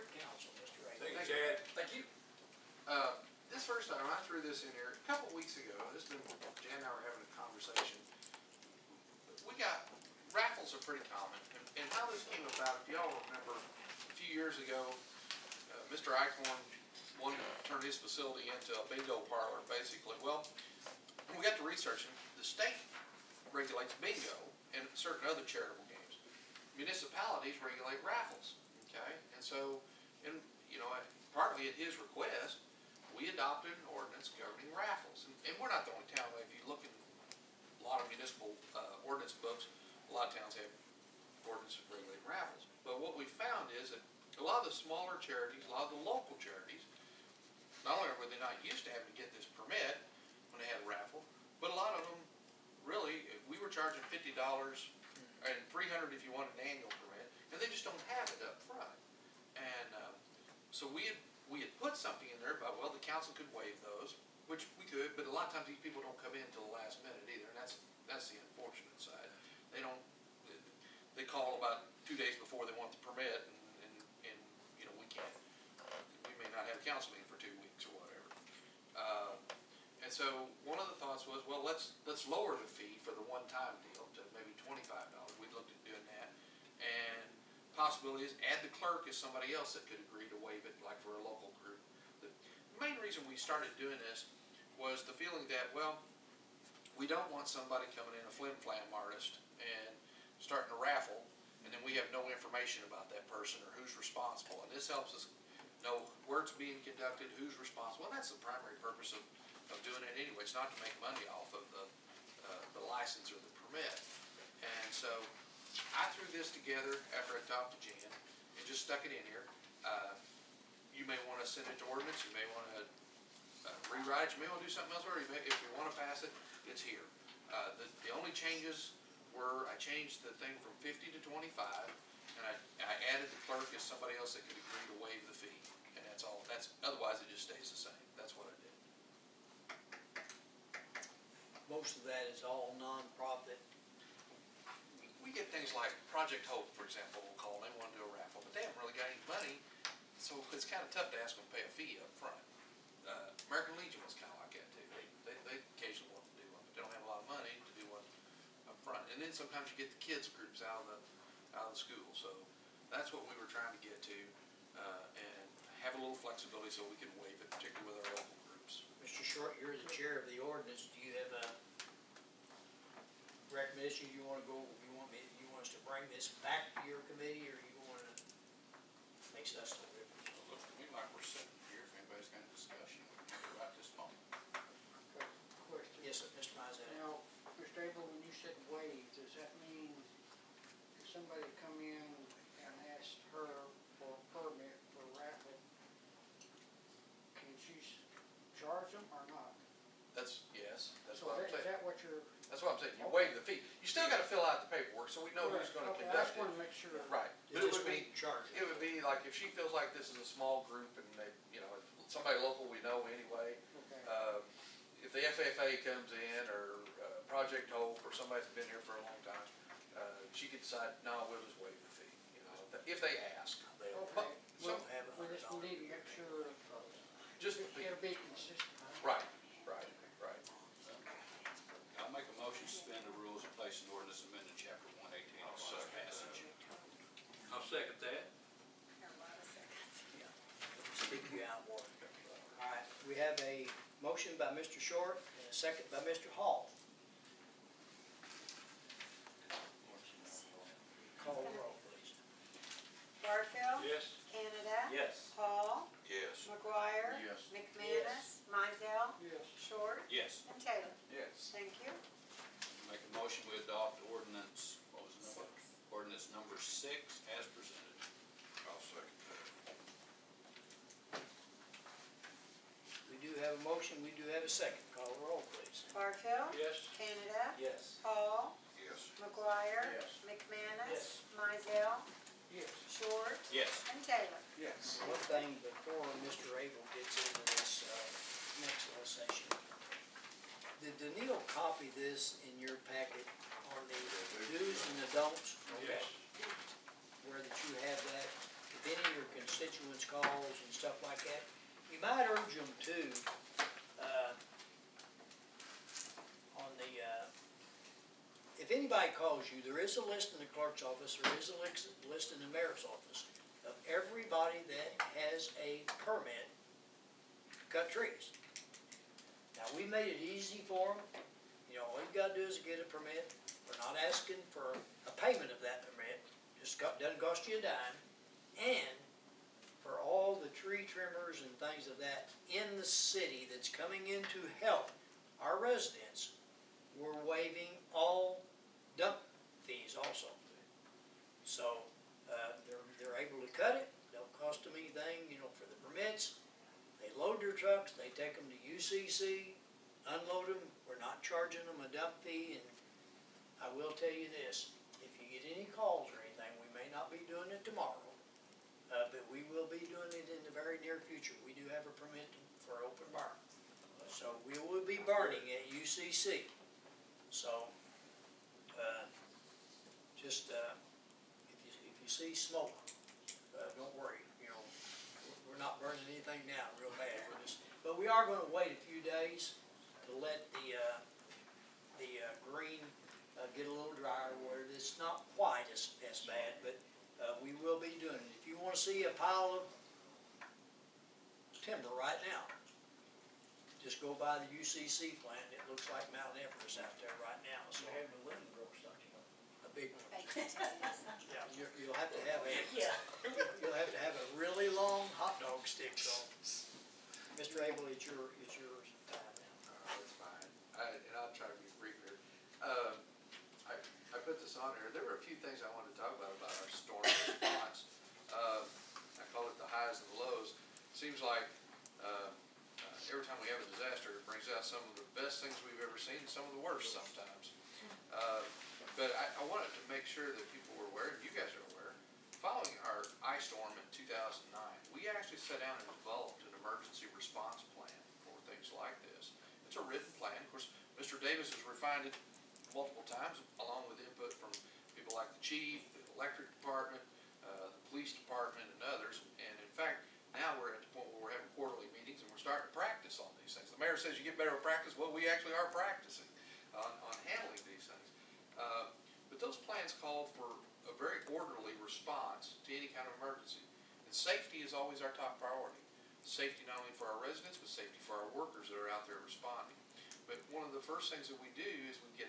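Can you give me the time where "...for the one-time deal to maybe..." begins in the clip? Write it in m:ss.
1:23.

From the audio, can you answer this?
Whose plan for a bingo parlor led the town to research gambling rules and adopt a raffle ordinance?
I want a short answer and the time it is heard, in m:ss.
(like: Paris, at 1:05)
Mr. Eichhorn, at 0:15.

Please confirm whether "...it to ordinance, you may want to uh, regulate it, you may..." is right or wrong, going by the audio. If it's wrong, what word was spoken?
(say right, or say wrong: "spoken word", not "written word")
wrong: "rewrite", not "regulate".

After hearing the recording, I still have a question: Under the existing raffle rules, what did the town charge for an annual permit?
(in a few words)
$300.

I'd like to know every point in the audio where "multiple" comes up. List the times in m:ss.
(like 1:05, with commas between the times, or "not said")
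7:22.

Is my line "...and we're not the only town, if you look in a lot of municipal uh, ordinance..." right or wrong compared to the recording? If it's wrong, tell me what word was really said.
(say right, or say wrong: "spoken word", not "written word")
right.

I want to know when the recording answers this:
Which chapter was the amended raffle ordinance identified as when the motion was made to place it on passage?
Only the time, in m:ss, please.
3:54.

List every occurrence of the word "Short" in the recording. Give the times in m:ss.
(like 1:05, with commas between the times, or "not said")
2:49, 4:04, 4:42.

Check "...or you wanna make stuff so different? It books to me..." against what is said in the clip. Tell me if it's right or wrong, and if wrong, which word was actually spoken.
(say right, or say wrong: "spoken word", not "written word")
wrong: "looks", not "books".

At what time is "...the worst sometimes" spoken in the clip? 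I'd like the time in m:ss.
7:06.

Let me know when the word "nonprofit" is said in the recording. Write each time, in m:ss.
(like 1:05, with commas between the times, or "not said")
2:22.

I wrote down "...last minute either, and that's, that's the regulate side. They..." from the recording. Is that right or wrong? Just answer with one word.
wrong.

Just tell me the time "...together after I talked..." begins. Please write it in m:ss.
1:56.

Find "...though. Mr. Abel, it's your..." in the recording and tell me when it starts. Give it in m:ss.
6:46.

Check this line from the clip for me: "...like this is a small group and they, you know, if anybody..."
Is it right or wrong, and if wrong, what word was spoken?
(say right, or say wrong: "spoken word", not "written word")
wrong: "somebody", not "anybody".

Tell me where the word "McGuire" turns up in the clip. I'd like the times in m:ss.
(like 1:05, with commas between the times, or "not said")
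4:16, 4:39.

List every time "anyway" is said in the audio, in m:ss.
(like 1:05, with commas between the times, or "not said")
1:50, 3:33.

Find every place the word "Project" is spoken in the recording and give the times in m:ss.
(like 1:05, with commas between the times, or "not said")
2:26, 3:37.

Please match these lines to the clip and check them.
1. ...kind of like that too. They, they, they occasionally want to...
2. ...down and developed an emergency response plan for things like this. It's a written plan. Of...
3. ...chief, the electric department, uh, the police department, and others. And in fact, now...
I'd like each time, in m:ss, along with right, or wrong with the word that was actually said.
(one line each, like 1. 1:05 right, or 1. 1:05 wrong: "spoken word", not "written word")
1. 2:34 right
2. 7:15 right
3. 7:25 right.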